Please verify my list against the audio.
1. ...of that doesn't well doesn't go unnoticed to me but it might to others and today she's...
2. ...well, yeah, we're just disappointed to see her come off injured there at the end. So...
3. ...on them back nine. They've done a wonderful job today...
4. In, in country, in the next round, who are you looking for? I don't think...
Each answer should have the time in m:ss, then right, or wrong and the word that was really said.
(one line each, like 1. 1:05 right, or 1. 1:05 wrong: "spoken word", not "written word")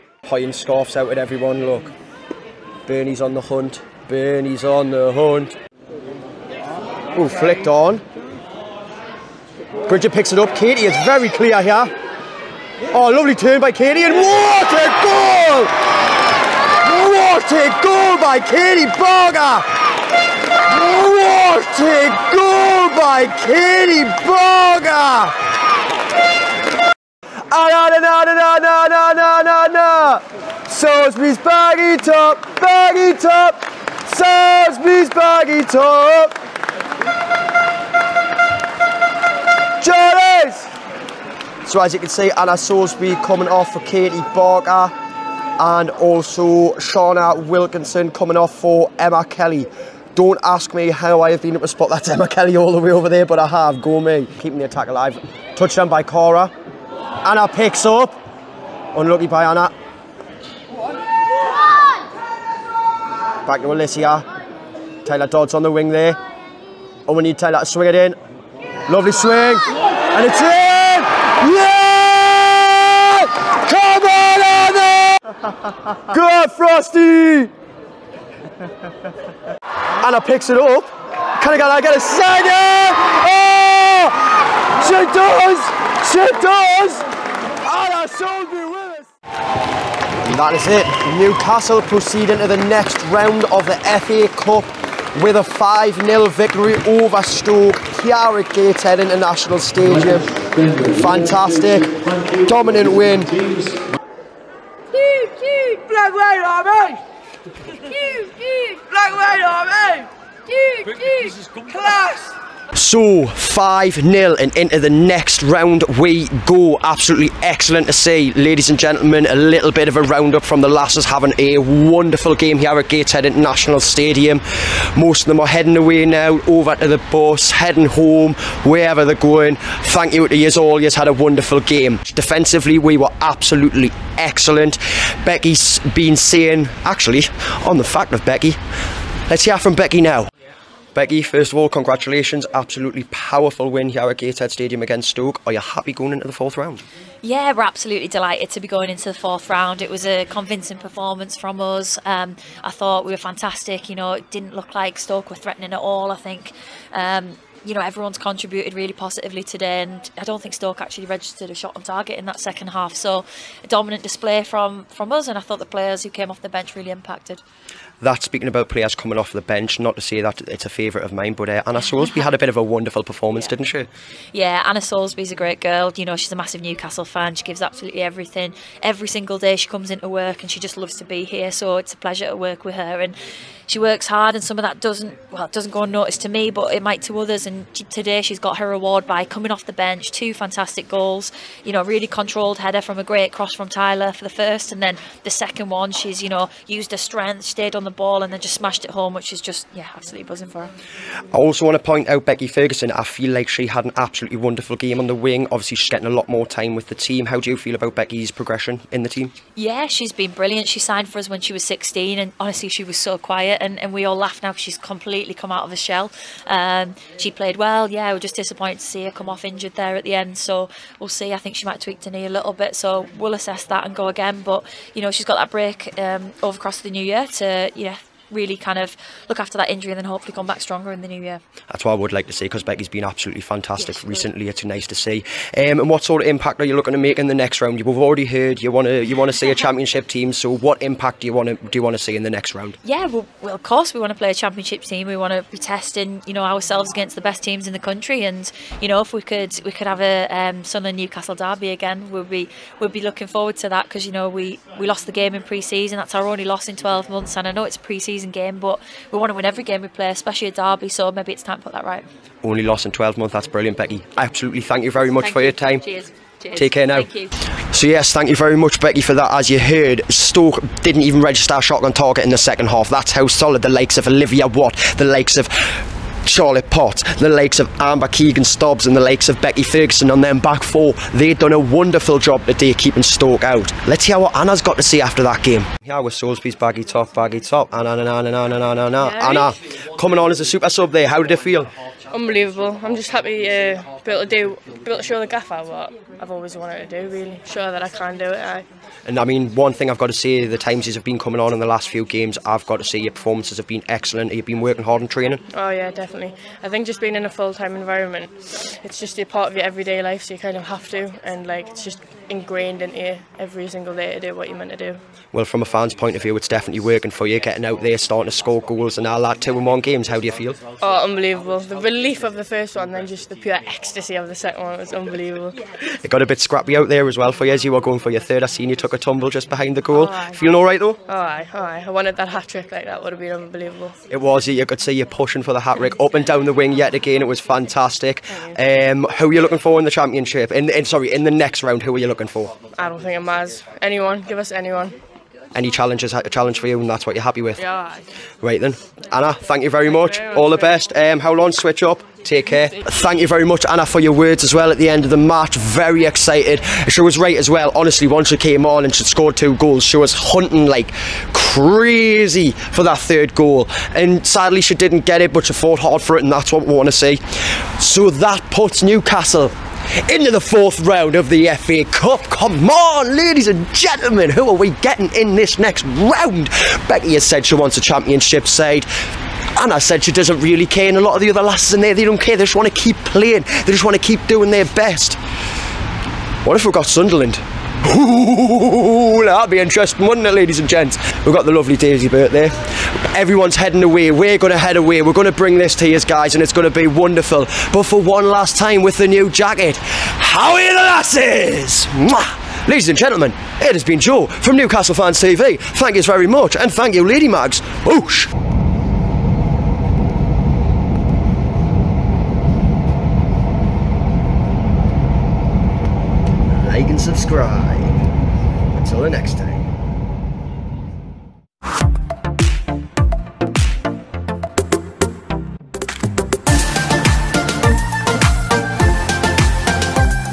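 1. 3:04 right
2. 3:37 right
3. 4:40 wrong: "four", not "nine"
4. 5:40 wrong: "sorry", not "country".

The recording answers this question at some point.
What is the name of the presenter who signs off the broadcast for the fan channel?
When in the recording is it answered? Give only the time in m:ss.
6:43.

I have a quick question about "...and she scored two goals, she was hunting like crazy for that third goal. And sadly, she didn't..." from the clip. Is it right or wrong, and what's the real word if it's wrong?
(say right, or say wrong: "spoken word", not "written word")
right.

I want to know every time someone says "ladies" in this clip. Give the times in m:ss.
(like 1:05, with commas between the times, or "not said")
1:58, 6:13, 6:30, 6:42.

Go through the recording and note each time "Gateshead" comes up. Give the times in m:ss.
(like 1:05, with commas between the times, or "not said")
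1:38, 2:02, 2:24.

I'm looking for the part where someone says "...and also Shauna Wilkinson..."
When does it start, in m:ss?
0:45.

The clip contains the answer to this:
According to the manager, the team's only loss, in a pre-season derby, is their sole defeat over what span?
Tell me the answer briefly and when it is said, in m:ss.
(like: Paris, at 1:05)
12 months, at 4:16.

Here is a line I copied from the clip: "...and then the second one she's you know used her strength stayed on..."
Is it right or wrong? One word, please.
right.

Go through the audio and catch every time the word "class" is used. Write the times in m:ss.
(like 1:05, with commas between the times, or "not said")
1:51.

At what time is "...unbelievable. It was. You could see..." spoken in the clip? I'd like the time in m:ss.
5:33.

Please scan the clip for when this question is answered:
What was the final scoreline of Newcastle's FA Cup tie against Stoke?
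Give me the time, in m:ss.
1:35.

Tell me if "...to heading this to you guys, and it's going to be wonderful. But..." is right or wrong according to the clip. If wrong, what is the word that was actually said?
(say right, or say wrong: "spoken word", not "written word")
wrong: "bring", not "heading".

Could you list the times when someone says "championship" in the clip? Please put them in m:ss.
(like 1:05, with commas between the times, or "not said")
3:59, 4:04, 5:39, 6:17.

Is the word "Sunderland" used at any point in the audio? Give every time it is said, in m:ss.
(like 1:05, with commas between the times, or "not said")
4:10, 6:26.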